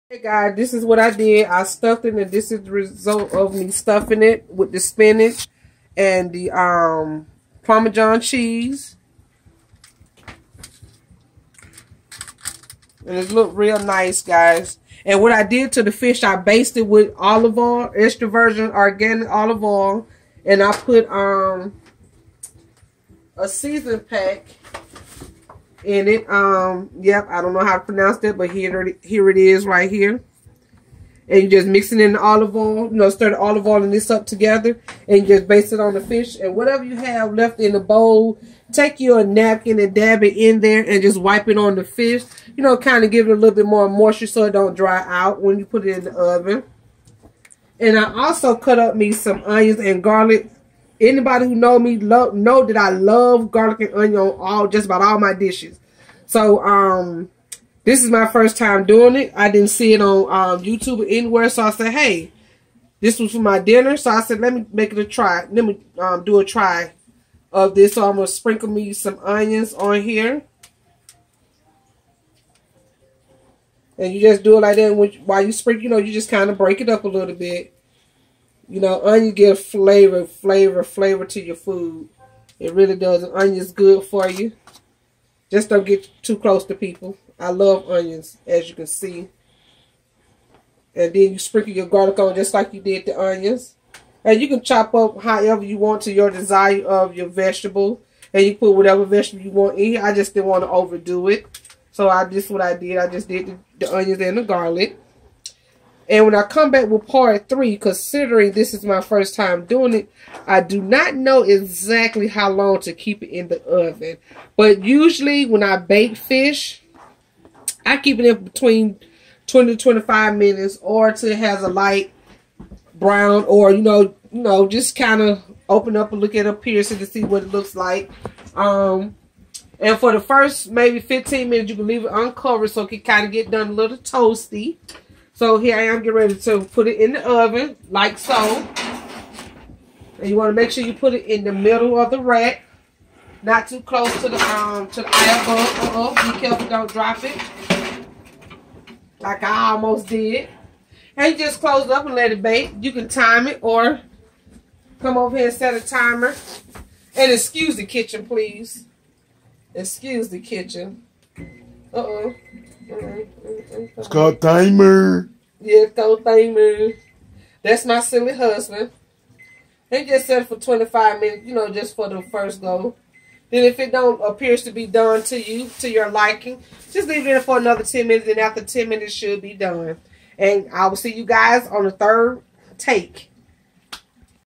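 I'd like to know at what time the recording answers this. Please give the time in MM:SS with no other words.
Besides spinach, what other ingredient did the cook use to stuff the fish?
00:07.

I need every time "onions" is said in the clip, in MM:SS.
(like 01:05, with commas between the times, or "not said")
00:49, 00:53, 01:09, 01:19, 01:23, 01:27, 01:33, 01:43.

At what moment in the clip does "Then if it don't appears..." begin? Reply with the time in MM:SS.
02:53.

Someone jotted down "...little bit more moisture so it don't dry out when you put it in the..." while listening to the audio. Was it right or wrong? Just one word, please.
right.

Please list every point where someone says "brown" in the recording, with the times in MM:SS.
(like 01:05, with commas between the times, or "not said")
02:02.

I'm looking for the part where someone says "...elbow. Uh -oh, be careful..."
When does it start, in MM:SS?
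02:25.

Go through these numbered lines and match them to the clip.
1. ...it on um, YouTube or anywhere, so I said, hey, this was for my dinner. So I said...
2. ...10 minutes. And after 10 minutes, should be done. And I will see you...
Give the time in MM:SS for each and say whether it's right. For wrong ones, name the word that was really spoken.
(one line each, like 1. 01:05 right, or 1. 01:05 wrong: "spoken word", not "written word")
1. 00:59 right
2. 02:57 right.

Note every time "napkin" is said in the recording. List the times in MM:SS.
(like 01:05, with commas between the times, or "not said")
00:39.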